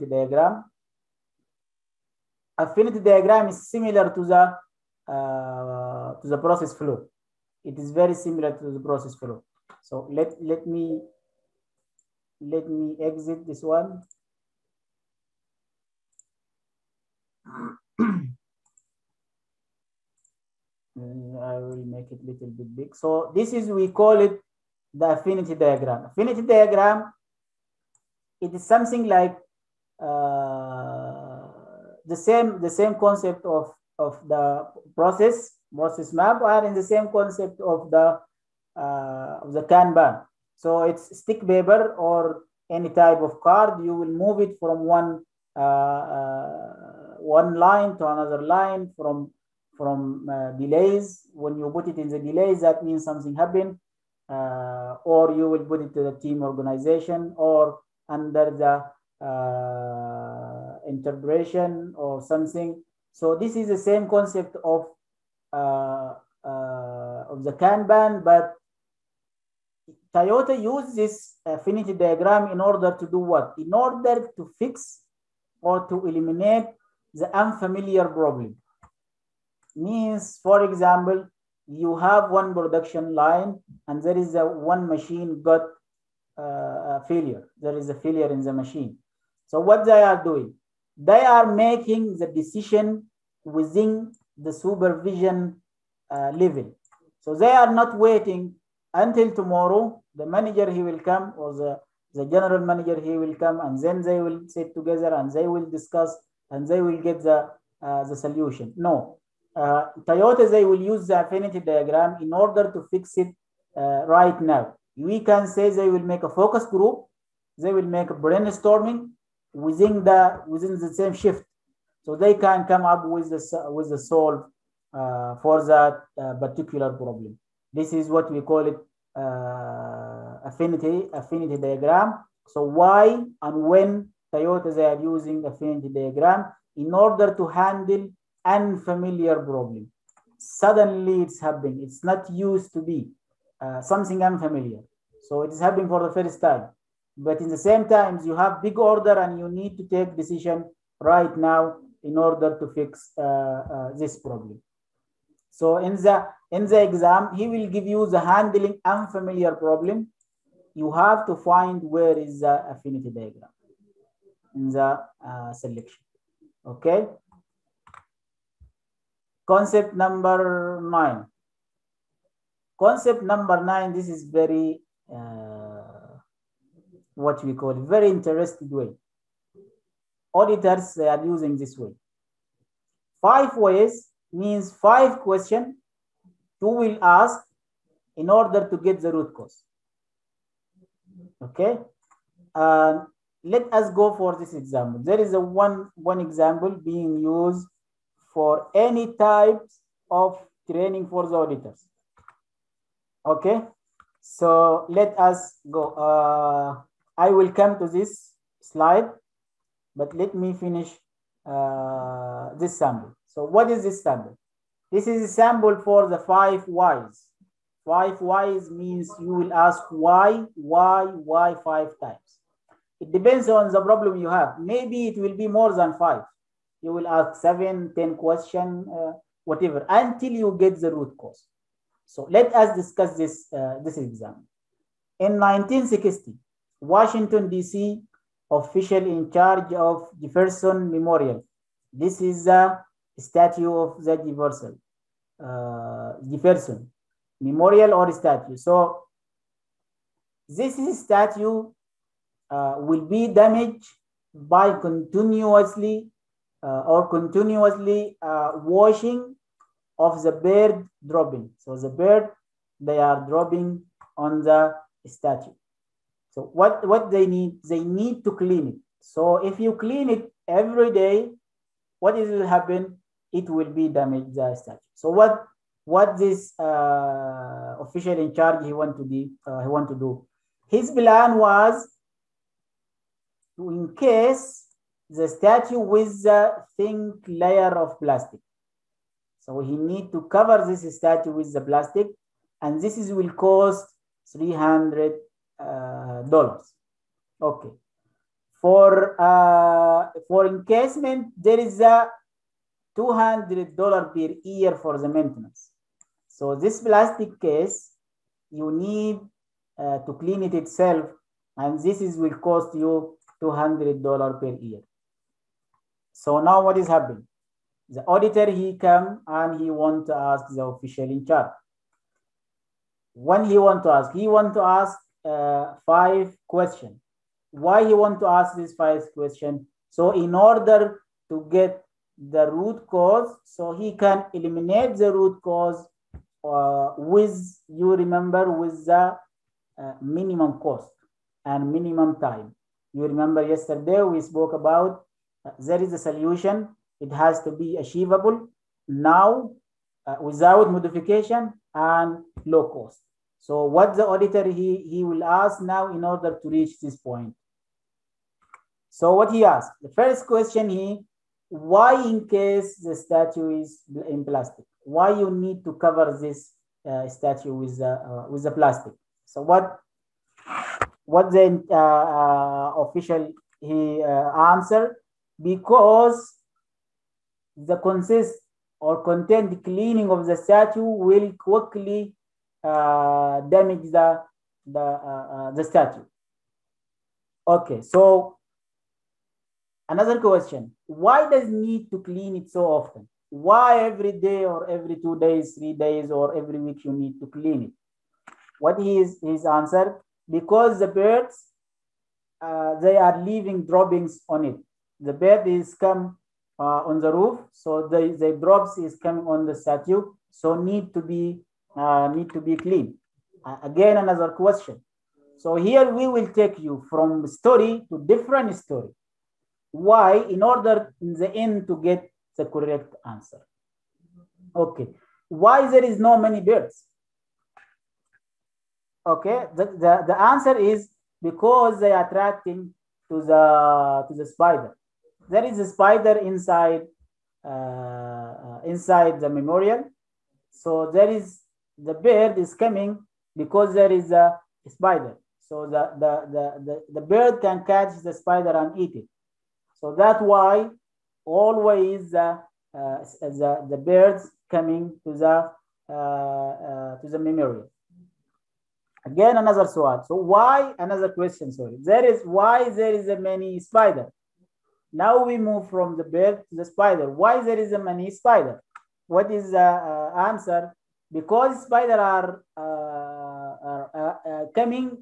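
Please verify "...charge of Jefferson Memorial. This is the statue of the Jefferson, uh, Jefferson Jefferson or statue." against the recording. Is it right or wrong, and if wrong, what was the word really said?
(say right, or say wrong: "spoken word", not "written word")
wrong: "Memorial", not "Jefferson".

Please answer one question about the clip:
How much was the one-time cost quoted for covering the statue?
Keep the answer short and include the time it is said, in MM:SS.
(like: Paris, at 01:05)
$300, at 04:54.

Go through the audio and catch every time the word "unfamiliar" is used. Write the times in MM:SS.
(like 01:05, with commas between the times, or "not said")
01:17, 02:18, 02:24, 02:38.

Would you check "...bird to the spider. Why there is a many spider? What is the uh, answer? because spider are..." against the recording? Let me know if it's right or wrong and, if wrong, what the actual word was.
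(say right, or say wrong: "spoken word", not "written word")
right.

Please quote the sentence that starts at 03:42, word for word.
It depends on the problem you have.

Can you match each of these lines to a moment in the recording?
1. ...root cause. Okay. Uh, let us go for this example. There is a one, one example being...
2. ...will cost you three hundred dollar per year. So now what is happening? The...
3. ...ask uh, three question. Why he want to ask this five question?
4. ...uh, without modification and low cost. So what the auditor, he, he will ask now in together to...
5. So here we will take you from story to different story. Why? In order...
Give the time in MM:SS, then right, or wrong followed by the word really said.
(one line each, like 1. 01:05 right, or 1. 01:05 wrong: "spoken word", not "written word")
1. 03:09 right
2. 05:12 wrong: "two", not "three"
3. 05:24 wrong: "five", not "three"
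4. 05:50 wrong: "order", not "together"
5. 06:55 right.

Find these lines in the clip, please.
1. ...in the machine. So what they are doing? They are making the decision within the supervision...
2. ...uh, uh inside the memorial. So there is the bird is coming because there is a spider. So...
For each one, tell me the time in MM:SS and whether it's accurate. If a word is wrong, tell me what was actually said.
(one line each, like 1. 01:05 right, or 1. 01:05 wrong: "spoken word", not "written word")
1. 01:28 right
2. 07:17 right.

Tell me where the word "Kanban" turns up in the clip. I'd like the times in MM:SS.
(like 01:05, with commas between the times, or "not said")
00:39, 01:07.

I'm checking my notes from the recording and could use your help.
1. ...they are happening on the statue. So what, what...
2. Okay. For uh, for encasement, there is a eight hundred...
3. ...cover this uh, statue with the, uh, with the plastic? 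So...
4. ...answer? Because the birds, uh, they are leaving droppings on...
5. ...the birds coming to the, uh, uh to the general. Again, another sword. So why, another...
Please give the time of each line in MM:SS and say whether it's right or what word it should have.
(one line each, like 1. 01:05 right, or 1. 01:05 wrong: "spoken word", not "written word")
1. 04:22 wrong: "dropping", not "happening"
2. 04:57 wrong: "two", not "eight"
3. 06:05 right
4. 06:39 right
5. 07:33 wrong: "memorial", not "general".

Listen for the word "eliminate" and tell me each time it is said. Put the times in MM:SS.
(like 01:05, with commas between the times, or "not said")
01:16, 05:34.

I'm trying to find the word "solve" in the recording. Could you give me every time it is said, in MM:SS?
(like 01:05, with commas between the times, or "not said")
02:03.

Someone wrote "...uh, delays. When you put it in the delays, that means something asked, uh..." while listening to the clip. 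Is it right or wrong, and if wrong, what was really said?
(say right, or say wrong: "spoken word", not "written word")
wrong: "happened", not "asked".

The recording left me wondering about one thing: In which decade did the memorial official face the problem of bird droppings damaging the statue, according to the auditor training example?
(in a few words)
1960.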